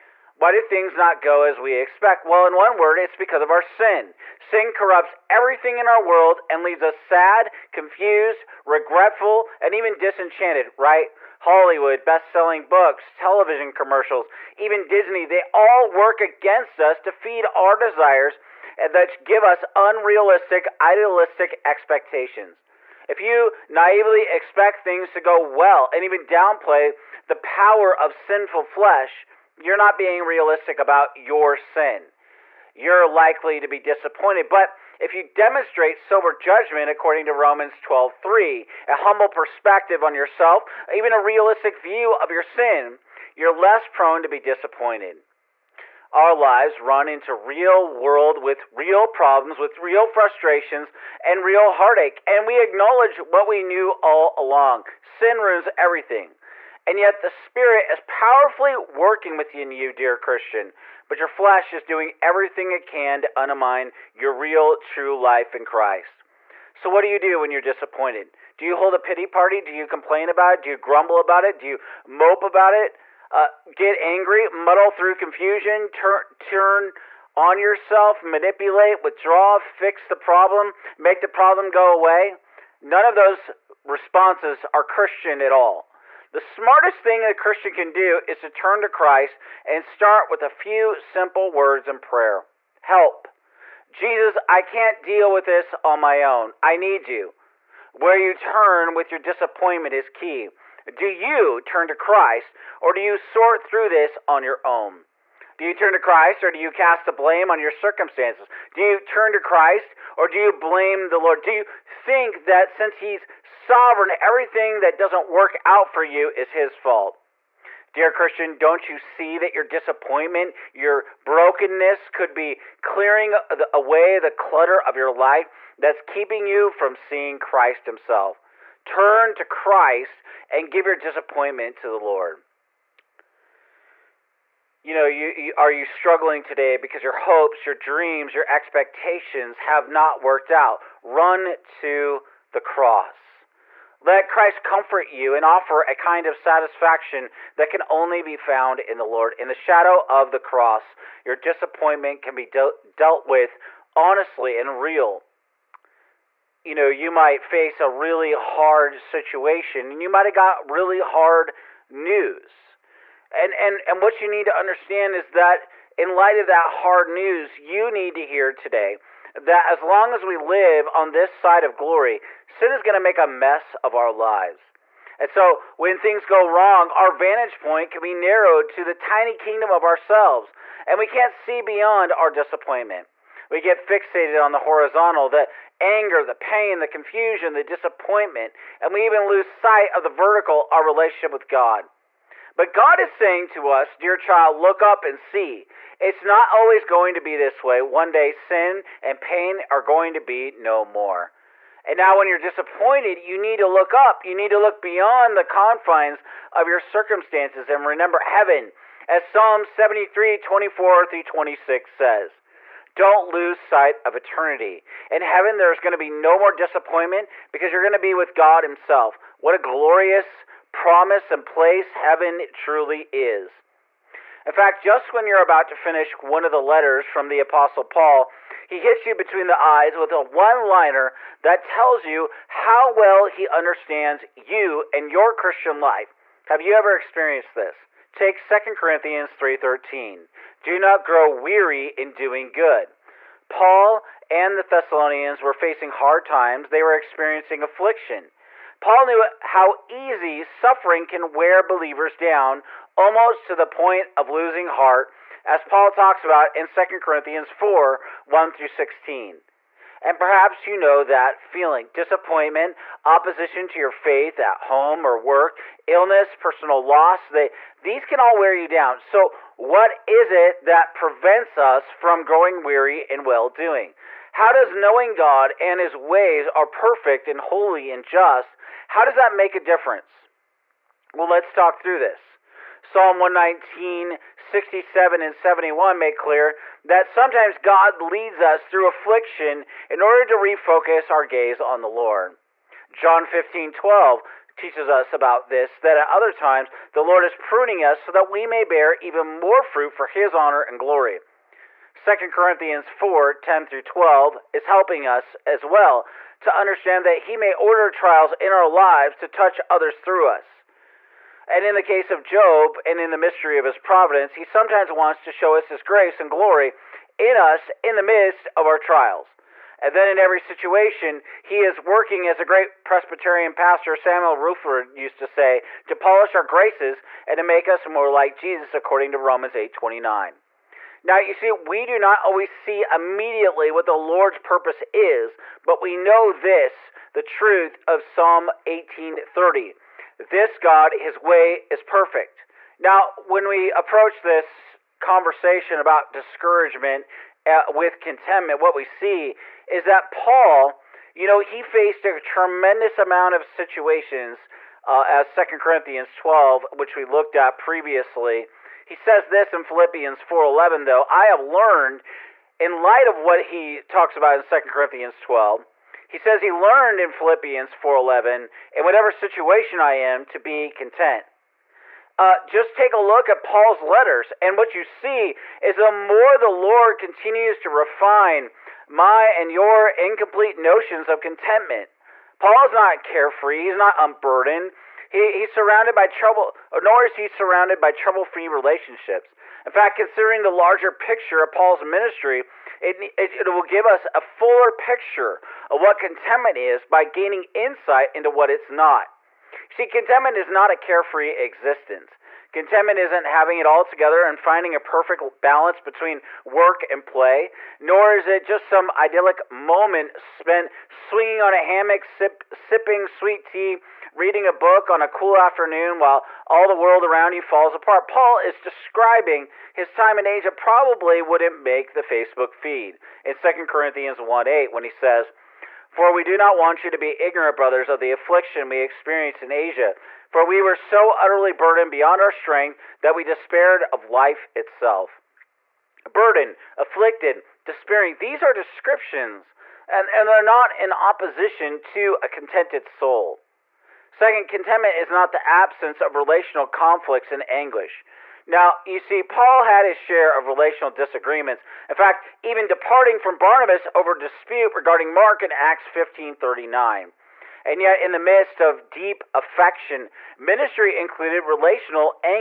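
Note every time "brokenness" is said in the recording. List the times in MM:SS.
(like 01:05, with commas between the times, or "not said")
02:01.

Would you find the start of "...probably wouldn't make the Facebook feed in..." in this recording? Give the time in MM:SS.
07:00.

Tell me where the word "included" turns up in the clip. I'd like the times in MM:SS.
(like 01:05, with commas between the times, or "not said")
07:40.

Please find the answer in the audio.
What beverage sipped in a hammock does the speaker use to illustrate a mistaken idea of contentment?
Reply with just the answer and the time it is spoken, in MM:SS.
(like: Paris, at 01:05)
sweet tea, at 06:53.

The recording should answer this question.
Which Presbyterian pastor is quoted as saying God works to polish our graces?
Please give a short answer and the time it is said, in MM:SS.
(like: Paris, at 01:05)
Samuel Rutherford, at 05:23.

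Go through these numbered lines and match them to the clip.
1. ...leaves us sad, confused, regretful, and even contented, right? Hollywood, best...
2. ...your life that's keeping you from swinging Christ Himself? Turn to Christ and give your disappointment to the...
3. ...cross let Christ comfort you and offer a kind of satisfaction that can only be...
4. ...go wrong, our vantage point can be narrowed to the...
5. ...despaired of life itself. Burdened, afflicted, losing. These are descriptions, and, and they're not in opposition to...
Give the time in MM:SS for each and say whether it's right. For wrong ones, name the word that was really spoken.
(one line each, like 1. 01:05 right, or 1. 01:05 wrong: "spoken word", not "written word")
1. 00:06 wrong: "disenchanted", not "contented"
2. 02:04 wrong: "seeing", not "swinging"
3. 02:22 right
4. 02:56 right
5. 07:13 wrong: "despairing", not "losing".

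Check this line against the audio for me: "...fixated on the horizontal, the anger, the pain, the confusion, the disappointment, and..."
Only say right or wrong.
right.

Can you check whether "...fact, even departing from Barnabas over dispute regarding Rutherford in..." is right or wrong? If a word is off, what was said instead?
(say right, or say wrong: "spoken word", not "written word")
wrong: "Mark", not "Rutherford".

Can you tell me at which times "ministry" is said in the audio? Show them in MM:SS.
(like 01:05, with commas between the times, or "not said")
06:31, 07:40.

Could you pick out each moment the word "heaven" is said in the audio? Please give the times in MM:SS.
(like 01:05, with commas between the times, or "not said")
03:28, 03:35, 03:41.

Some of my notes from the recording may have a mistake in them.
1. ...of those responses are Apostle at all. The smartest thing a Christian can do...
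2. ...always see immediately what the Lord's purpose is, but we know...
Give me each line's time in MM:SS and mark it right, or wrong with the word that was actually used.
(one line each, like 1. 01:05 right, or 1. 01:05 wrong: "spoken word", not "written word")
1. 01:23 wrong: "Christian", not "Apostle"
2. 05:32 right.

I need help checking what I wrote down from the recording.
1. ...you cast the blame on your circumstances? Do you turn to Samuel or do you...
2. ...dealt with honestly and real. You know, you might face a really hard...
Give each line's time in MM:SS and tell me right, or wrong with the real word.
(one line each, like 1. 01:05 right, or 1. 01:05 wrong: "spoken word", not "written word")
1. 01:46 wrong: "Christ", not "Samuel"
2. 02:32 right.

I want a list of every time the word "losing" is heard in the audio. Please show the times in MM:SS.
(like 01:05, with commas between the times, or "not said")
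04:14.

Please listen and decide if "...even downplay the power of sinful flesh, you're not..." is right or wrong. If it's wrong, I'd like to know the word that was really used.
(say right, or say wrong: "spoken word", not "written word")
right.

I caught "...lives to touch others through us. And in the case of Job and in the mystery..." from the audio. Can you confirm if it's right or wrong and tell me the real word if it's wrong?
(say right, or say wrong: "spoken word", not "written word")
right.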